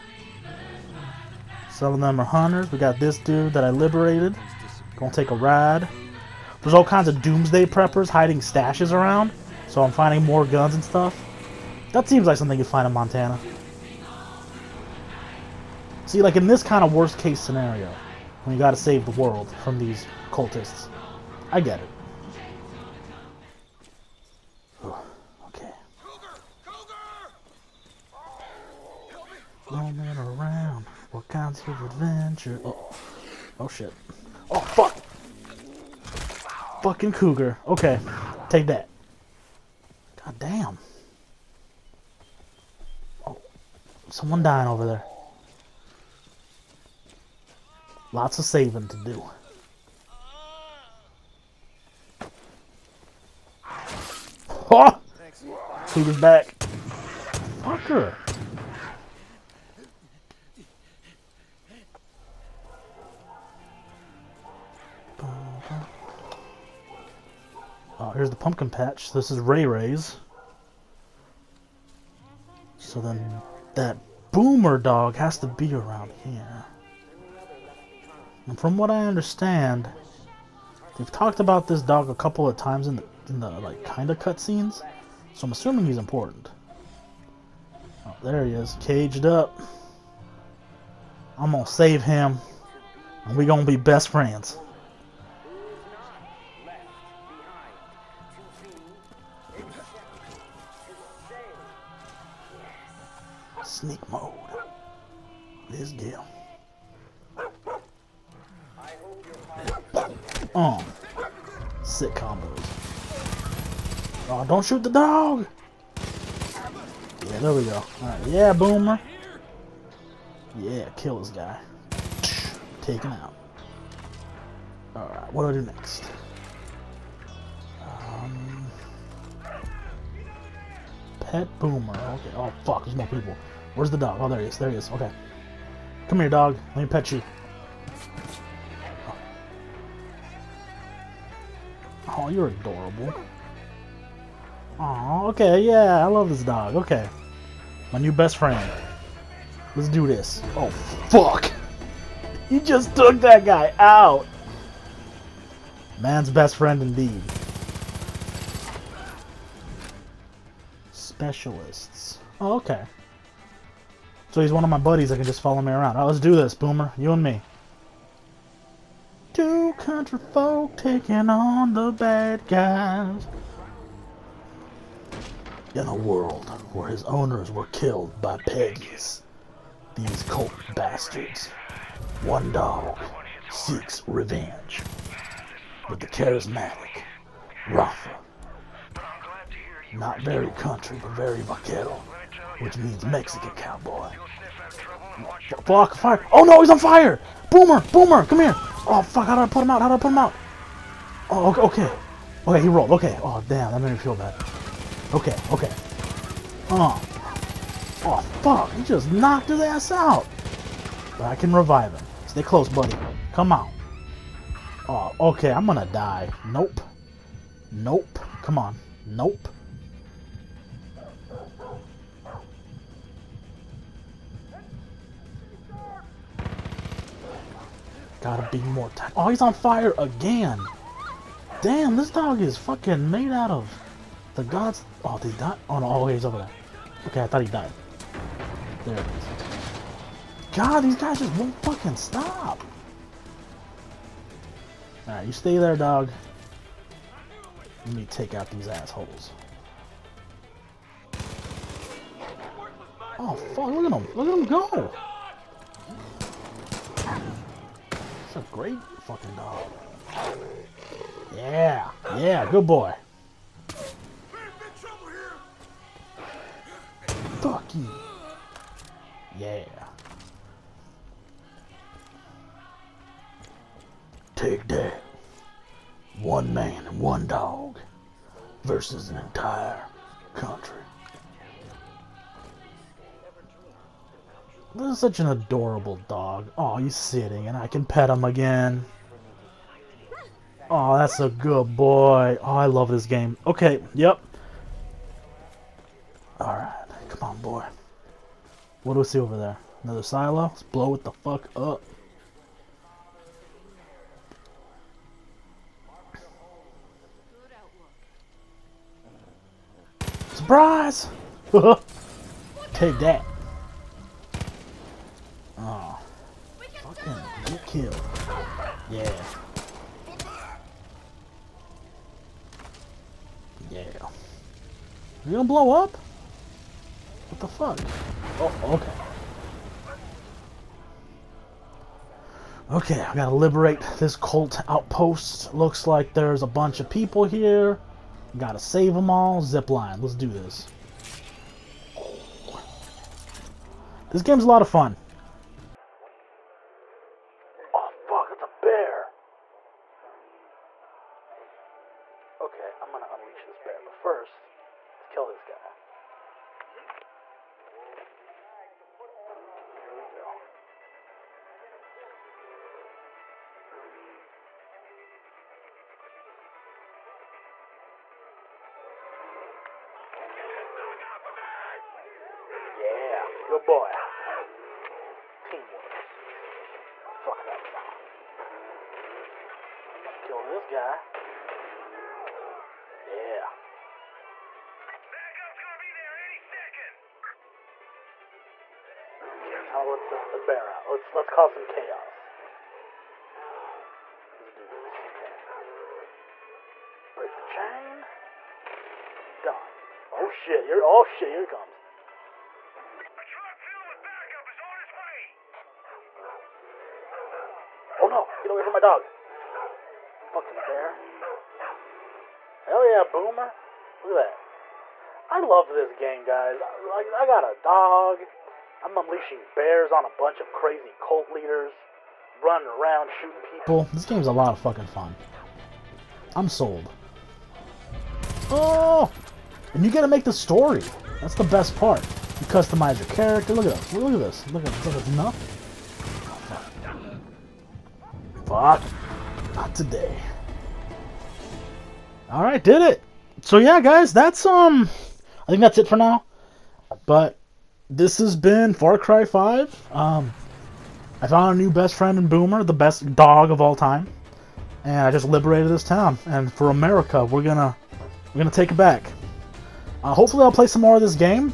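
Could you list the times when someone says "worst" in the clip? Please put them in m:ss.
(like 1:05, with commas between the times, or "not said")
0:16.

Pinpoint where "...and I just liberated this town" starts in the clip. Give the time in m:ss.
7:34.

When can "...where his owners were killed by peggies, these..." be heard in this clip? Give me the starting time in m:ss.
2:56.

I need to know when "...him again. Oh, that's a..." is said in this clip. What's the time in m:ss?
4:48.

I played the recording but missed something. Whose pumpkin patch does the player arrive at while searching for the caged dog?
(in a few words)
Rae Rae's.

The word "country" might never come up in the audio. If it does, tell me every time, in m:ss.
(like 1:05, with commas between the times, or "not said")
2:49, 3:10, 4:40.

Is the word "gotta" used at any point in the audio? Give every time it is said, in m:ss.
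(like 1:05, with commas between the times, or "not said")
0:18, 3:48, 5:33, 5:38, 7:09.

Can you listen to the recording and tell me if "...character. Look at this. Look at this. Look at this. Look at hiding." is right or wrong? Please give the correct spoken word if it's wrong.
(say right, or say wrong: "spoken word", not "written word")
wrong: "nothing", not "hiding".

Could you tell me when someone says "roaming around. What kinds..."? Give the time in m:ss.
0:29.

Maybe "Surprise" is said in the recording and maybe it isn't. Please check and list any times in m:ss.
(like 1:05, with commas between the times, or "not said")
5:10.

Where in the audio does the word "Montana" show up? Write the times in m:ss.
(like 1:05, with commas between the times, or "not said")
0:12.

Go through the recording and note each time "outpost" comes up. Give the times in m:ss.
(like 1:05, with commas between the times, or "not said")
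5:34.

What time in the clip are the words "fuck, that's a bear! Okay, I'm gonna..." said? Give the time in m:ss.
5:48.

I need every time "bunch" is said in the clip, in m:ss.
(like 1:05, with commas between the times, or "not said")
5:36, 7:00.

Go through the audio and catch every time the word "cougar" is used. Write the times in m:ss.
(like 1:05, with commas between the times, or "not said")
0:37, 0:55.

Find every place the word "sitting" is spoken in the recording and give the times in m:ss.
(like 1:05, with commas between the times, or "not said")
4:46.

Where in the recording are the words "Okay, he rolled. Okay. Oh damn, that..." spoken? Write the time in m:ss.
3:22.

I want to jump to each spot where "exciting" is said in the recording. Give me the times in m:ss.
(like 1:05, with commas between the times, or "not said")
not said.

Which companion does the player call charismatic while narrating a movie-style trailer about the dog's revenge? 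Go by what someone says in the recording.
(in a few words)
Rafa.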